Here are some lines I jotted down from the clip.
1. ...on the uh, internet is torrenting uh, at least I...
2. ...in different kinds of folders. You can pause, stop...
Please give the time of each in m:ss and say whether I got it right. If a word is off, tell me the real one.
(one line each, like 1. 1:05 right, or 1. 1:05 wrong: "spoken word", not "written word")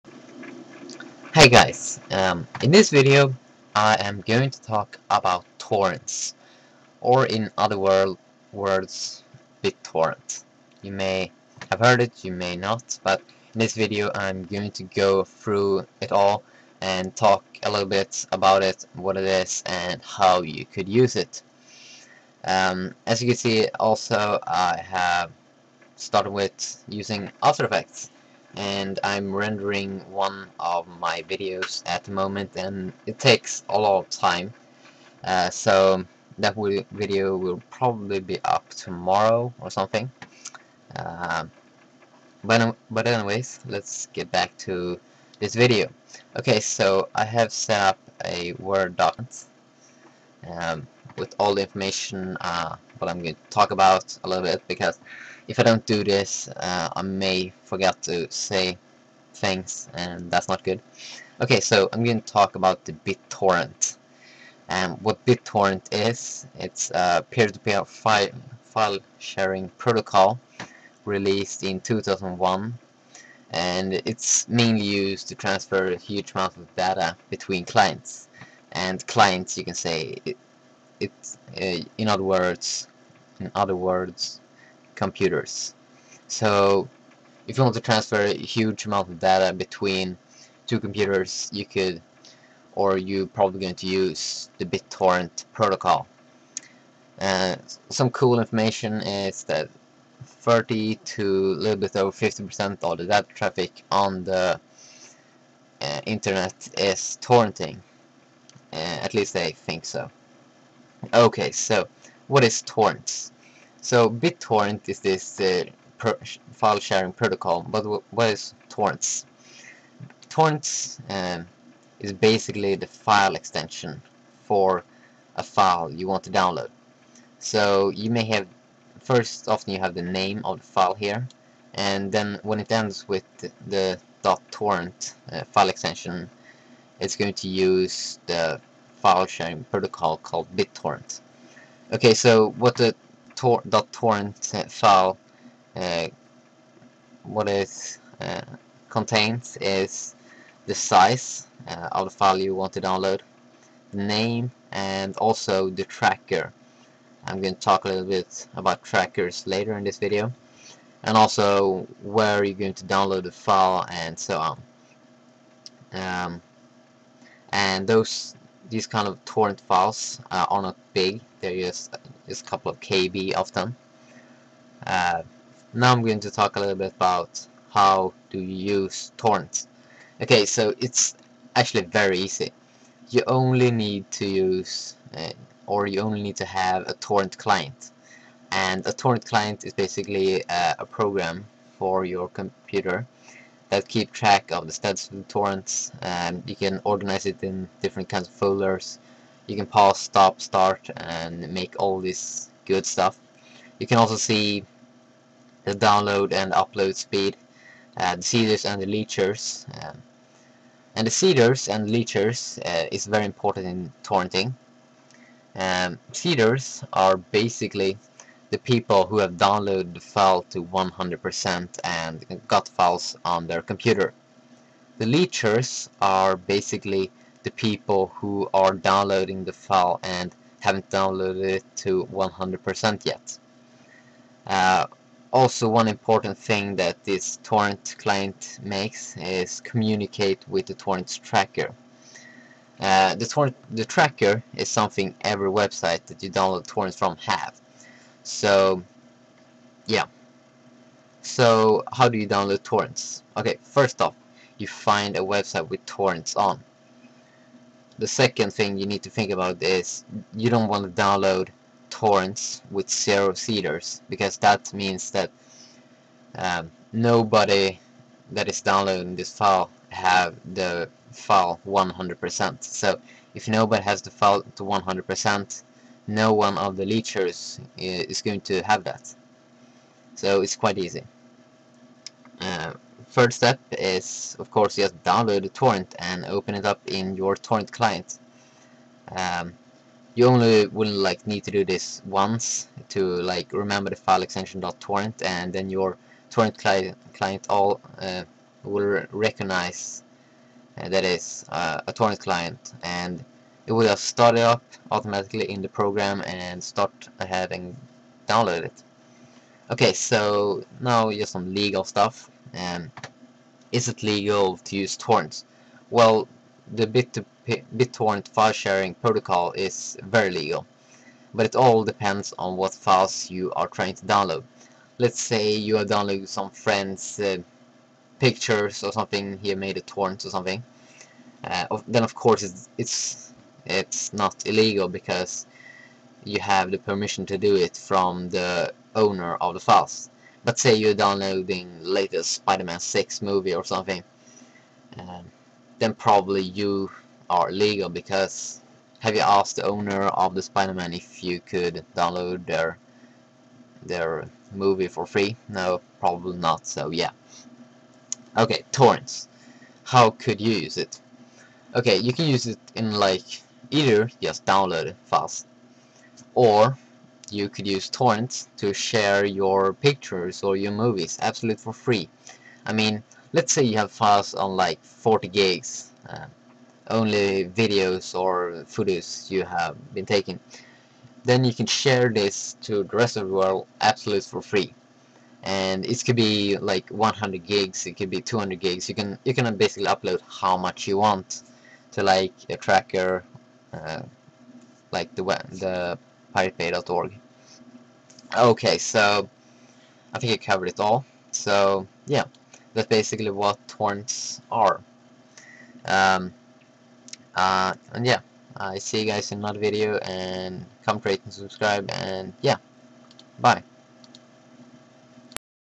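1. 1:43 right
2. 3:17 right.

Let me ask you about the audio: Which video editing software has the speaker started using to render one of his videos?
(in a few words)
After Effects.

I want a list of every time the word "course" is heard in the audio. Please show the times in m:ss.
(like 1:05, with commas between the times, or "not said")
4:44, 5:32.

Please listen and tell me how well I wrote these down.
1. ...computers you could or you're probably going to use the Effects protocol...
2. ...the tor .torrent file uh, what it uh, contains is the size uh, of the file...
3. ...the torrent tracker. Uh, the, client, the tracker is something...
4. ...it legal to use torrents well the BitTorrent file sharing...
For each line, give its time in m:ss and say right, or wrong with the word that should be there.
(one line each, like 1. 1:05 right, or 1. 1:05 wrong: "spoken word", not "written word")
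1. 1:30 wrong: "BitTorrent", not "Effects"
2. 2:22 right
3. 4:00 wrong: "torrent", not "client"
4. 5:13 right.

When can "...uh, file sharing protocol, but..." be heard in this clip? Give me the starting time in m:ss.
1:55.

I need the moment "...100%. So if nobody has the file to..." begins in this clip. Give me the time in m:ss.
4:31.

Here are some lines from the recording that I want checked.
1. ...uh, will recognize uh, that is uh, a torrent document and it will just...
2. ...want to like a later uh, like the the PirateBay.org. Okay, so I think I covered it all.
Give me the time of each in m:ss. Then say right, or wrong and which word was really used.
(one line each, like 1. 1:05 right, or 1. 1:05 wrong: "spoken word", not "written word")
1. 4:57 wrong: "client", not "document"
2. 6:30 wrong: "tracker", not "later".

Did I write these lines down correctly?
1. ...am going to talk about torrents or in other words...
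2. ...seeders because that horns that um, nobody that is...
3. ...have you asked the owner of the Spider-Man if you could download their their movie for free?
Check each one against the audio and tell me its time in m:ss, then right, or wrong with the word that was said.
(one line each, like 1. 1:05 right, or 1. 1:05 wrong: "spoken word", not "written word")
1. 0:04 right
2. 4:23 wrong: "means", not "horns"
3. 5:48 right.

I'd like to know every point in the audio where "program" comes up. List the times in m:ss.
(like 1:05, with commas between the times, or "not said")
3:10, 5:05.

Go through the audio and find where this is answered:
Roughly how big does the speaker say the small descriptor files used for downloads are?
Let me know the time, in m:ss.
2:52.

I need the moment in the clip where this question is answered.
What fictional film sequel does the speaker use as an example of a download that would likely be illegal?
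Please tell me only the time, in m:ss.
5:42.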